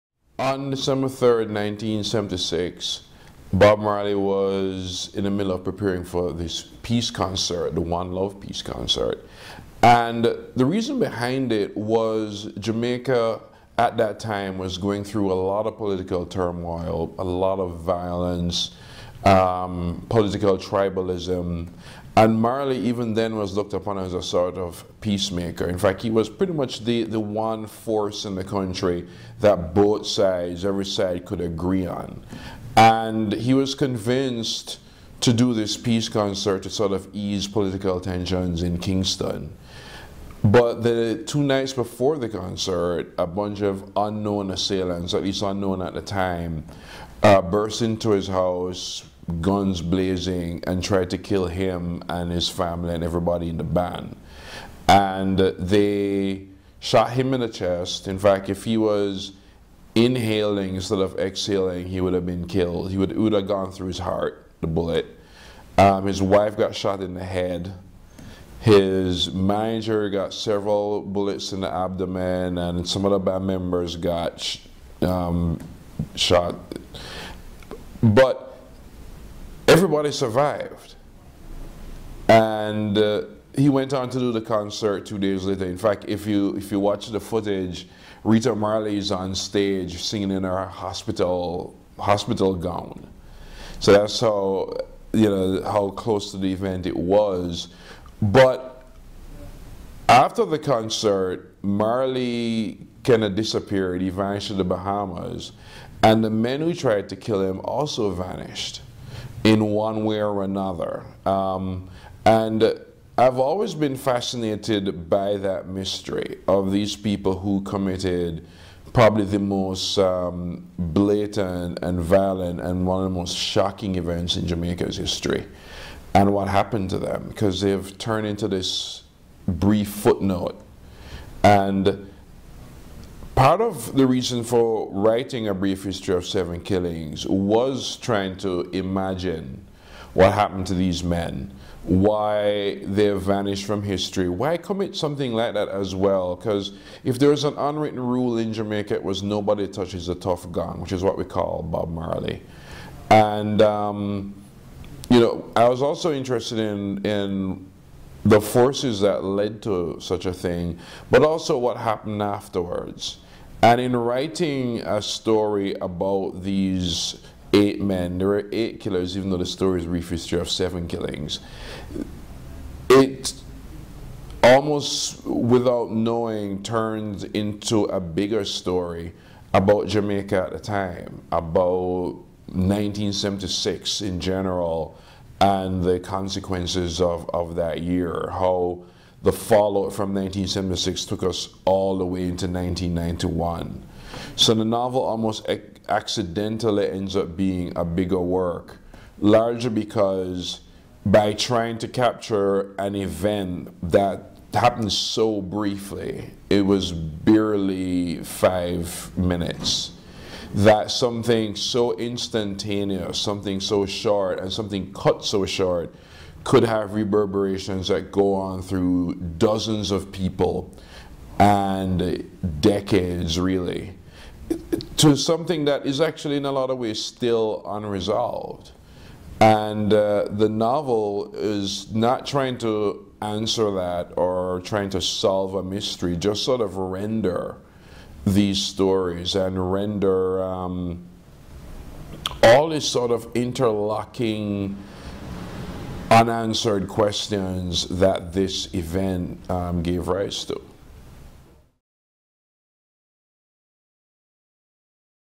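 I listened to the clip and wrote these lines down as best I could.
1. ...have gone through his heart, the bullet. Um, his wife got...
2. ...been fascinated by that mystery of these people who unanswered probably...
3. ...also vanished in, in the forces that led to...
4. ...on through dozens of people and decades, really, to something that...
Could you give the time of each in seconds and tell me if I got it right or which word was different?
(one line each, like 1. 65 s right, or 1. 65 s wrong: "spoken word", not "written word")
1. 63 s right
2. 113 s wrong: "committed", not "unanswered"
3. 155 s wrong: "interested", not "vanished"
4. 218 s right.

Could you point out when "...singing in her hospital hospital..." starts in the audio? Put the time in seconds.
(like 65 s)
90 s.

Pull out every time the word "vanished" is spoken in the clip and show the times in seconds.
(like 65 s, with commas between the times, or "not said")
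104 s, 108 s, 143 s.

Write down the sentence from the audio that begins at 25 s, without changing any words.
In fact, he was pretty much the, the one force in the country that both sides, every side, could agree on.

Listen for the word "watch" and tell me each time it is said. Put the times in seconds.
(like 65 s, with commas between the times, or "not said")
86 s.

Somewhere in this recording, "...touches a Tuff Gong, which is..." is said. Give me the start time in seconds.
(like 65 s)
149 s.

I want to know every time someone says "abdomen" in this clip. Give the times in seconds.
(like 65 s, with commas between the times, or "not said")
71 s.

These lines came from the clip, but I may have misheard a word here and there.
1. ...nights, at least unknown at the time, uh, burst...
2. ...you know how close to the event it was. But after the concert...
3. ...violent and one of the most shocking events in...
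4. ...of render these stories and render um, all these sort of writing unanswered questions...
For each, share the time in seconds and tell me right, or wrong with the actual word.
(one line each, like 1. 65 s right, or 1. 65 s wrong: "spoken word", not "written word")
1. 44 s wrong: "assailants", not "nights"
2. 95 s right
3. 121 s right
4. 236 s wrong: "interlocking", not "writing".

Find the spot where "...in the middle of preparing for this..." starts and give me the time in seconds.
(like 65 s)
5 s.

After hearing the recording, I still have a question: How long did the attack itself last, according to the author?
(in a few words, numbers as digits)
5 minutes.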